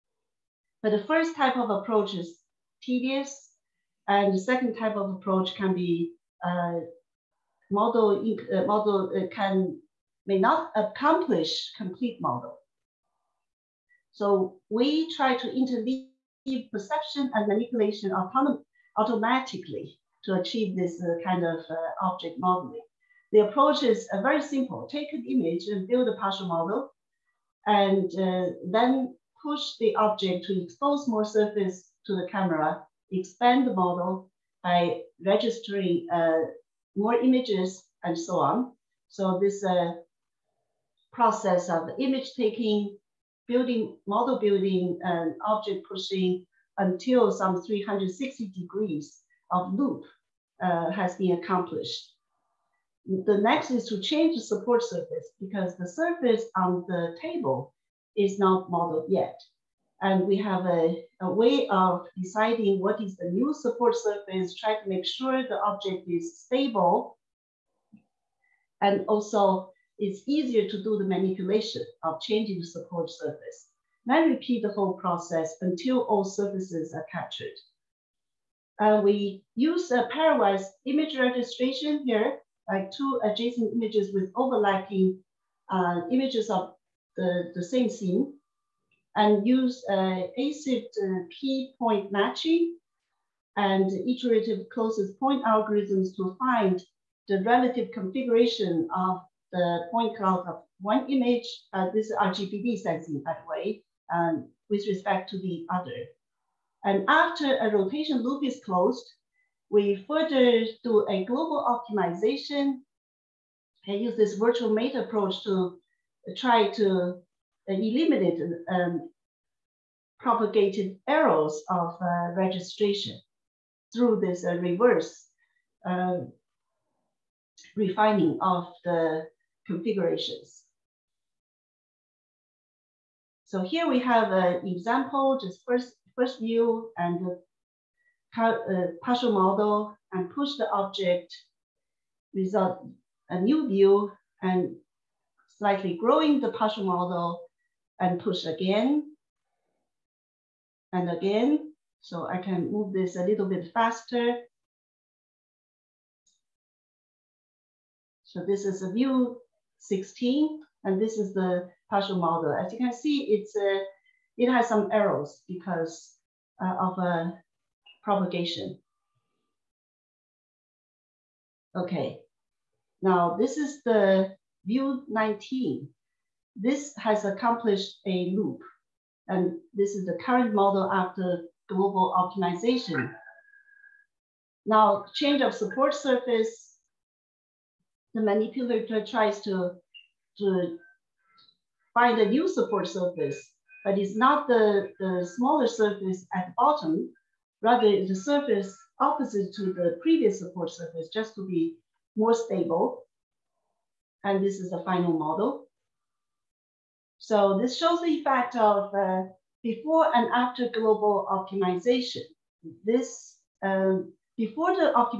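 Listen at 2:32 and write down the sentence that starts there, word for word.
So I can move this a little bit faster.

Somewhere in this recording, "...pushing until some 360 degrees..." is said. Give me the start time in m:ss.
0:45.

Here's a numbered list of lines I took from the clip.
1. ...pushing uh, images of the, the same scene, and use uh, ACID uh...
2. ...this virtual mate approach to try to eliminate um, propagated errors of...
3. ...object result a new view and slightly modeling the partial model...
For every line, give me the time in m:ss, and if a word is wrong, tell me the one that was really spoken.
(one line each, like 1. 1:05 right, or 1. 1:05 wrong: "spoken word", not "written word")
1. 1:24 wrong: "overlapping", not "pushing"
2. 1:54 right
3. 2:20 wrong: "growing", not "modeling".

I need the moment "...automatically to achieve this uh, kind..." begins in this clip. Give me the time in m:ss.
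0:18.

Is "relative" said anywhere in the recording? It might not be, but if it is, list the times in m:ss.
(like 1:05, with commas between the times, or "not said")
1:37.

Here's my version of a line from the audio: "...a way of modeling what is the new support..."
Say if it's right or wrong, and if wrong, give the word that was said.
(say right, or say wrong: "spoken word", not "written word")
wrong: "deciding", not "modeling".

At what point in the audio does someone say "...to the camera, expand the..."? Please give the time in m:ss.
0:32.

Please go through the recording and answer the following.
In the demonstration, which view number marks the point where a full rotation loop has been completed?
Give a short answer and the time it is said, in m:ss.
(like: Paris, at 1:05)
19, at 2:54.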